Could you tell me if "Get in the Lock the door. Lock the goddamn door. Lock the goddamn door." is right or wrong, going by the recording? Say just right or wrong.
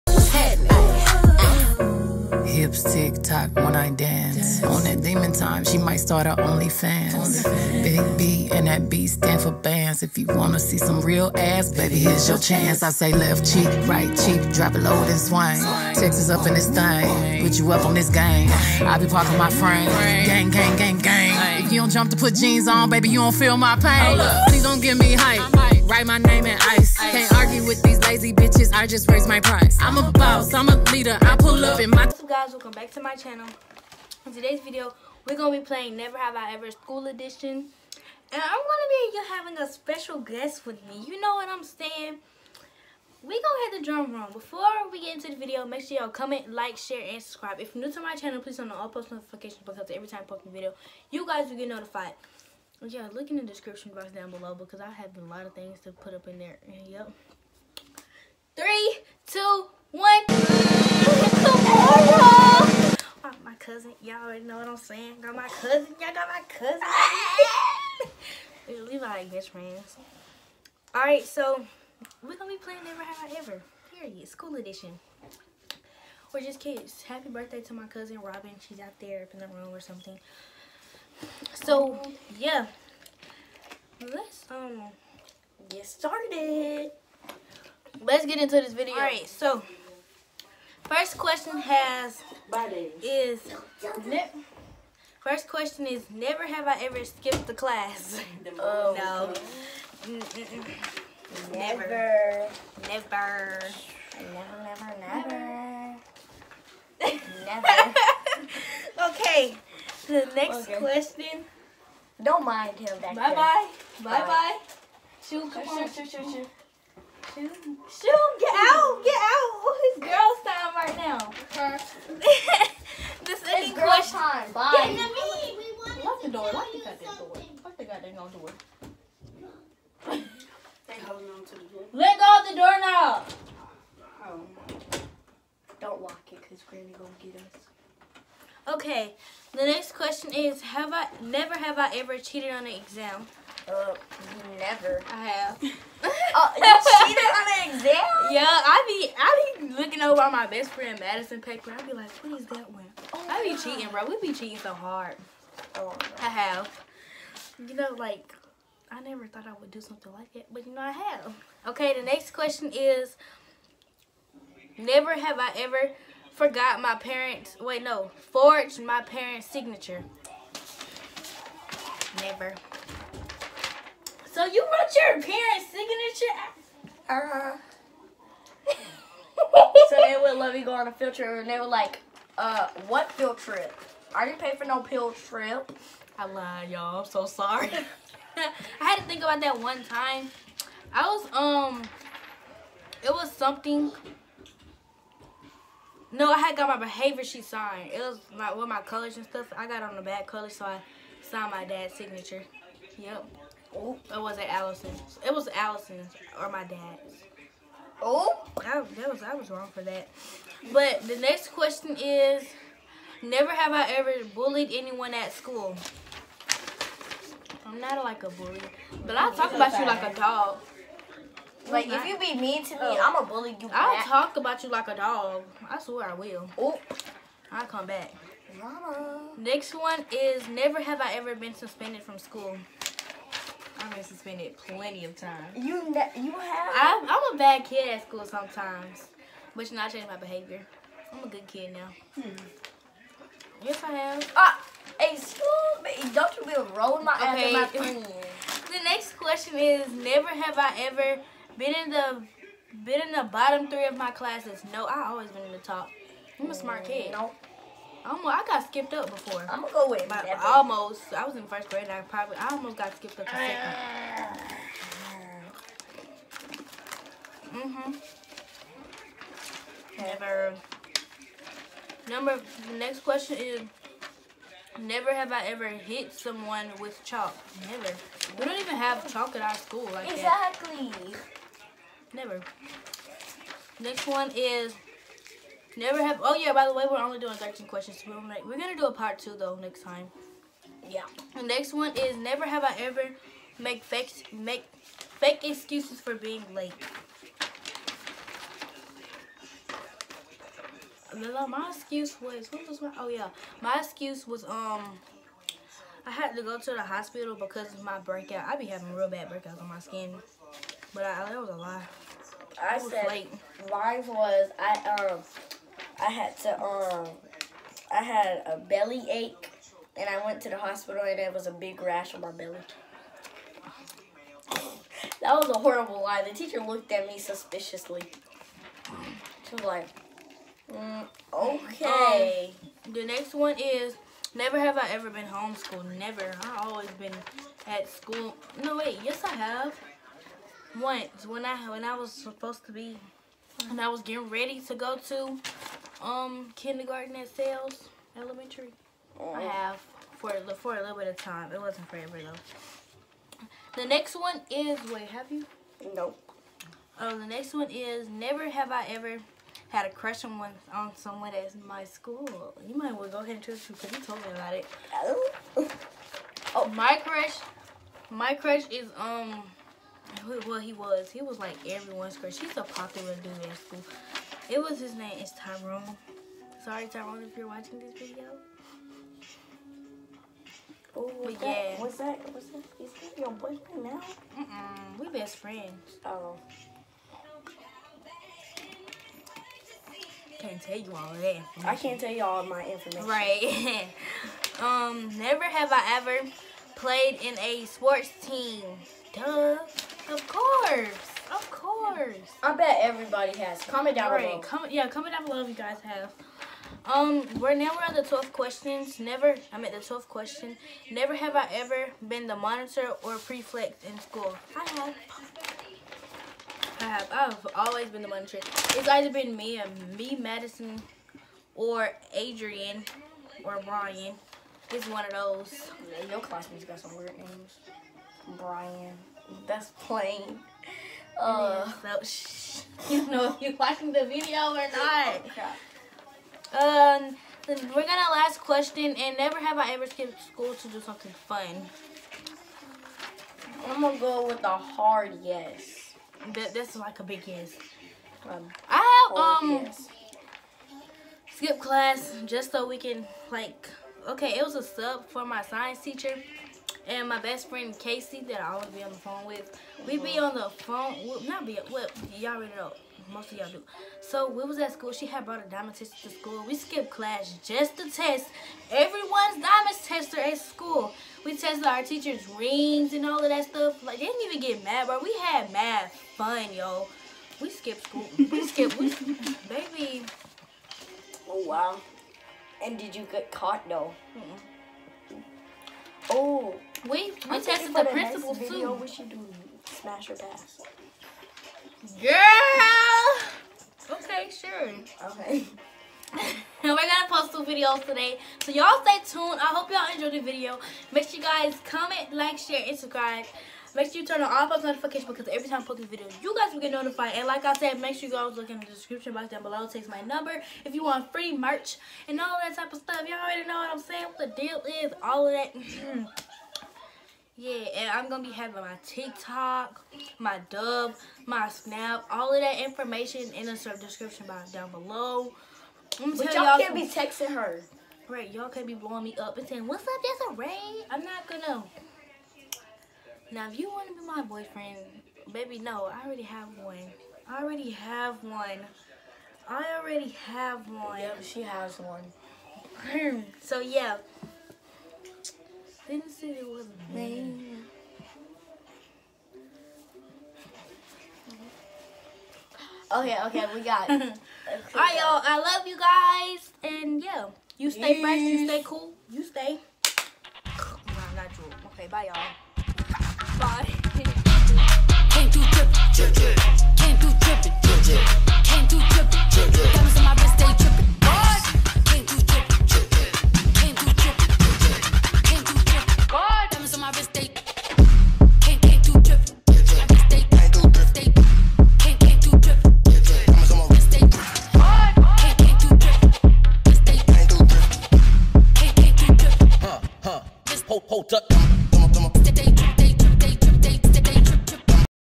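right.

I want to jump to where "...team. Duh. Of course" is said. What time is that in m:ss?
6:38.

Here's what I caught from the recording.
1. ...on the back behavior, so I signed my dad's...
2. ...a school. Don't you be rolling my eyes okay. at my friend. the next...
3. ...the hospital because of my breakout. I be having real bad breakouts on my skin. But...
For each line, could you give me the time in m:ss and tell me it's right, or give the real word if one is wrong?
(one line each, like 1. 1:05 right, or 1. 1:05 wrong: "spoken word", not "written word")
1. 3:19 wrong: "color", not "behavior"
2. 4:05 right
3. 5:06 right.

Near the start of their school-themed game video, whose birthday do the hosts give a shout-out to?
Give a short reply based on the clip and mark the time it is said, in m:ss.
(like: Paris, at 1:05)
Robin, at 1:18.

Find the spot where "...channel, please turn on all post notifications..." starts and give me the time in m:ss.
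0:48.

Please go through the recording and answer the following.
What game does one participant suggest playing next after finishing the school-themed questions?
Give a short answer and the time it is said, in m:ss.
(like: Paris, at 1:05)
smash or pass, at 8:09.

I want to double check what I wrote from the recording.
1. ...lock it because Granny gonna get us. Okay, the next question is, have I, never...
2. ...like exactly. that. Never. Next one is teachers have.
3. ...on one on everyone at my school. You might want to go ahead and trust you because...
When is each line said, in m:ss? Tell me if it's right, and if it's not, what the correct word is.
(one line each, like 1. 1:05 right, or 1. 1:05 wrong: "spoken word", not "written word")
1. 2:16 right
2. 4:39 wrong: "never", not "teachers"
3. 6:00 wrong: "someone", not "everyone".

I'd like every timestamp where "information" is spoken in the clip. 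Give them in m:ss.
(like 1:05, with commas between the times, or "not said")
6:32, 8:42.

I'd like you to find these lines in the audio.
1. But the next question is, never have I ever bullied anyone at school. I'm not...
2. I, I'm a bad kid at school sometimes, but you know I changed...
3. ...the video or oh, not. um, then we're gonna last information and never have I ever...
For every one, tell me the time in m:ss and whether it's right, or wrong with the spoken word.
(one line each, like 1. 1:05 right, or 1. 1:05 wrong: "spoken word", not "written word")
1. 3:30 right
2. 3:56 right
3. 7:13 wrong: "question", not "information".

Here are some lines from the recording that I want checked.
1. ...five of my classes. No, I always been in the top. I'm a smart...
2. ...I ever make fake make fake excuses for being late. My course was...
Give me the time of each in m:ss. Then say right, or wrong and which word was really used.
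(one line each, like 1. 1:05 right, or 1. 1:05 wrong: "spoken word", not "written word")
1. 4:13 wrong: "three", not "five"
2. 4:52 wrong: "excuse", not "course".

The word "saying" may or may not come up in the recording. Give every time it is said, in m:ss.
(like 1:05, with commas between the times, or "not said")
0:41, 1:04, 8:33, 8:49.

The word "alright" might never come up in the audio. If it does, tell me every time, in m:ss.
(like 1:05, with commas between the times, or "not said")
1:28, 9:13.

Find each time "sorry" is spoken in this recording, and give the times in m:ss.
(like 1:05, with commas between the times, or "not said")
3:07, 6:16.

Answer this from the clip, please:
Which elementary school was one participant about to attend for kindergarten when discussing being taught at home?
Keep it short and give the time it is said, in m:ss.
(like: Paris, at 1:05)
Sales Elementary, at 5:47.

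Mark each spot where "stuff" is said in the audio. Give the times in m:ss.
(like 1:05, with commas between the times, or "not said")
3:19, 7:53, 8:32.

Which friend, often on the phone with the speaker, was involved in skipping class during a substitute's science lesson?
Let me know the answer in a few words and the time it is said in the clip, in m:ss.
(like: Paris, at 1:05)
Casey, at 7:37.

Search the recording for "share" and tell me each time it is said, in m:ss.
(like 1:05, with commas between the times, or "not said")
0:46, 8:22.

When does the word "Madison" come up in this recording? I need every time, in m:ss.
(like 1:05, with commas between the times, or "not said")
2:30, 7:00.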